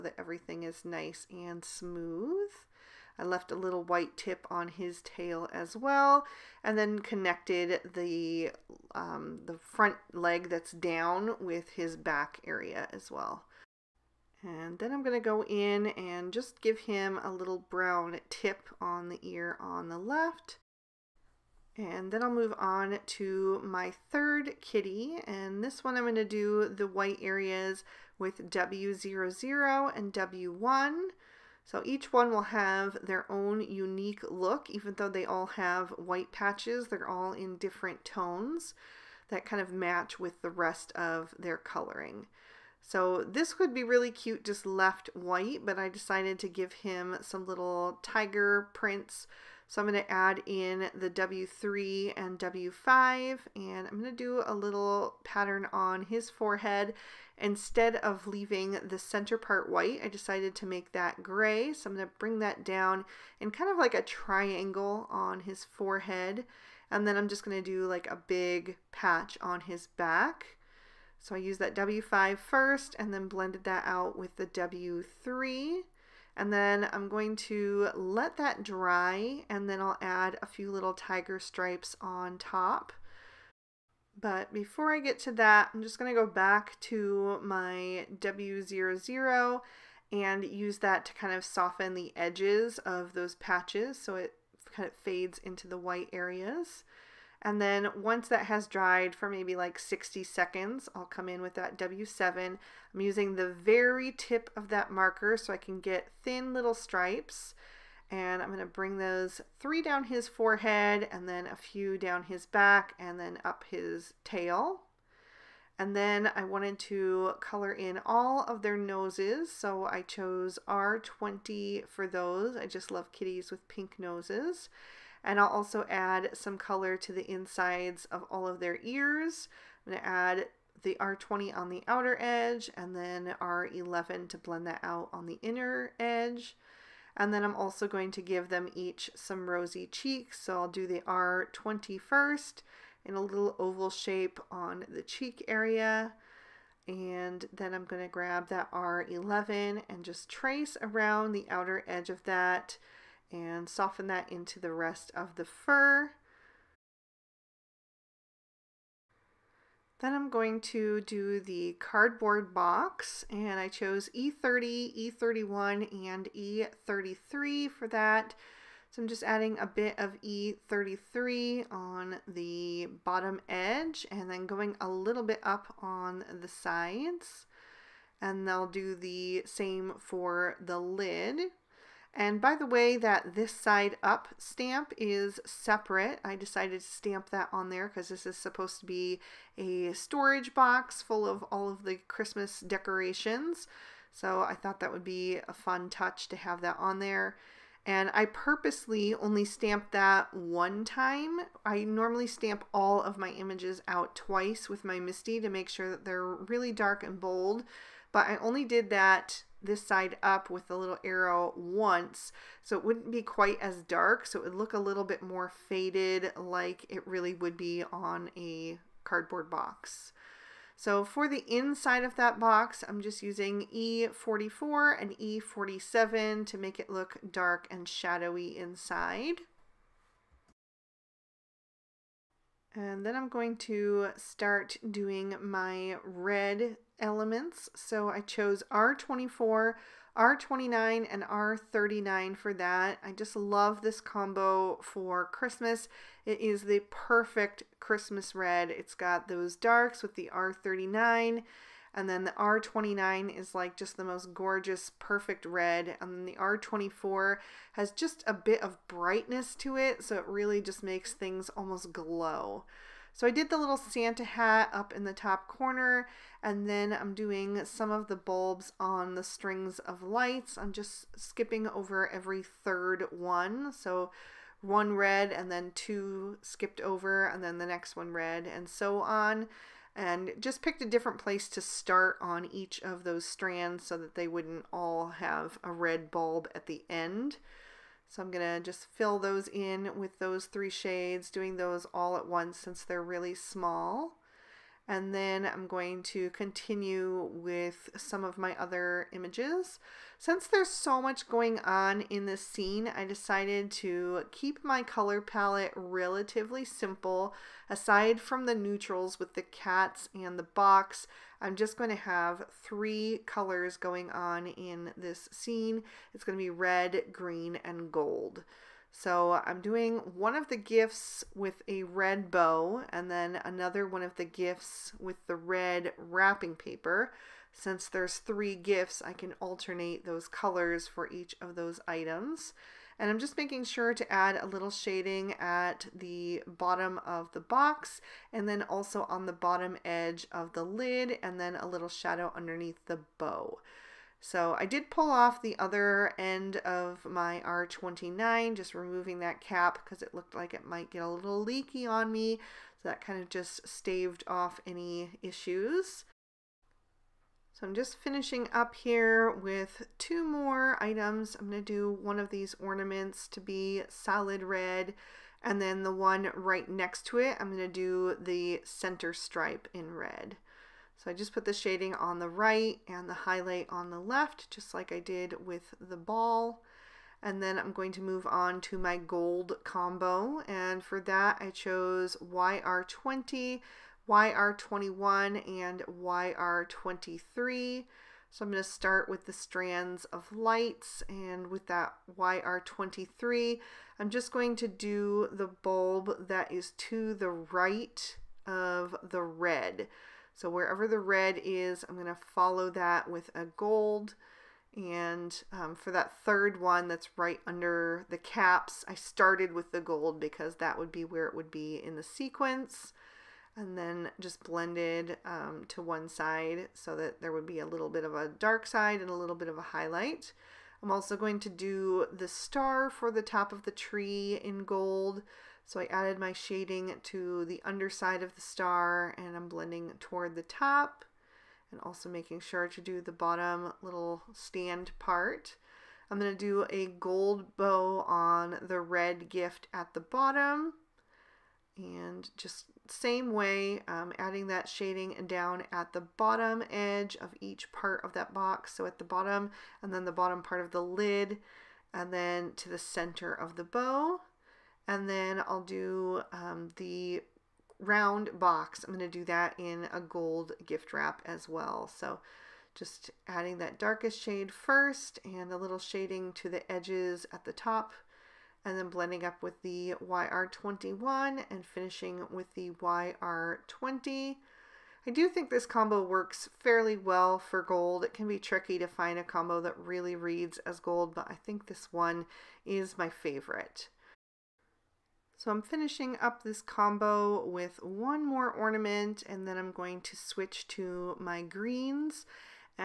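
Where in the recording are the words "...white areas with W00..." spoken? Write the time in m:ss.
0:26.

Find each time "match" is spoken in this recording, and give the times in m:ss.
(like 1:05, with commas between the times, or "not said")
0:39.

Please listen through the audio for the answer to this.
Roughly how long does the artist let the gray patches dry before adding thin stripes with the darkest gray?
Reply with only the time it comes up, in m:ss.
1:39.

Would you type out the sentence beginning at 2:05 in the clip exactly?
And I'll also add some color to the insides of all of their ears.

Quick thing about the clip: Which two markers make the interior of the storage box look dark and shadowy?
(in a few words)
E44 and E47.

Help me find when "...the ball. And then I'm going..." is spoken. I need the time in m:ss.
6:15.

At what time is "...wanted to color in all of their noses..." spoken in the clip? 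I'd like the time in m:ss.
1:56.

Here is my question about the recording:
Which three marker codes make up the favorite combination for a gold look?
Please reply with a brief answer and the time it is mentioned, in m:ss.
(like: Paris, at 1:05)
YR20, YR21, and YR23, at 6:22.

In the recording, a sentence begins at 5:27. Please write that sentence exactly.
Since there's three gifts, I can alternate those colors for each of those items.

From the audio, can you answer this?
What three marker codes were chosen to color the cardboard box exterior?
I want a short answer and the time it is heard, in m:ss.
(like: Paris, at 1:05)
E30, E31, and E33, at 2:44.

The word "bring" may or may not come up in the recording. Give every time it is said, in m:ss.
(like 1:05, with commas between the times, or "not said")
1:02, 1:48.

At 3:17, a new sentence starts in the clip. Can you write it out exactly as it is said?
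And I purposely only stamped that one time.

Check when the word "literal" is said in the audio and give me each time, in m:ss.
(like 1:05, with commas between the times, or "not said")
not said.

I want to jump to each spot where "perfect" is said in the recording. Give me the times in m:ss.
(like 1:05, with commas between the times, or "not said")
4:06, 4:14.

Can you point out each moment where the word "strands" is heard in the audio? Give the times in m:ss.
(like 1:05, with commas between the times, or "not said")
4:43, 6:29.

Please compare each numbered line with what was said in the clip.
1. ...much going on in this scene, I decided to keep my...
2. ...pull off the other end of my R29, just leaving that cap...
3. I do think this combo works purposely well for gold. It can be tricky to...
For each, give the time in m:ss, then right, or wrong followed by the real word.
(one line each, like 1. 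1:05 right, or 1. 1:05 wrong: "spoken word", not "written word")
1. 5:00 right
2. 5:44 wrong: "removing", not "leaving"
3. 7:55 wrong: "fairly", not "purposely".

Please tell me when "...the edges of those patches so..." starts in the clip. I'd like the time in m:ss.
1:31.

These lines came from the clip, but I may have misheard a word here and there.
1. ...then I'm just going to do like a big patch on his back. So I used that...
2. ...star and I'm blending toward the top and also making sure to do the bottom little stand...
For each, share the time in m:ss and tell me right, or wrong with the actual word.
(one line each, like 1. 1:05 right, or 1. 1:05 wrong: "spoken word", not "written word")
1. 1:07 right
2. 7:08 right.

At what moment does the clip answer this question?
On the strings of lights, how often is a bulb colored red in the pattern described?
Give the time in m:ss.
4:32.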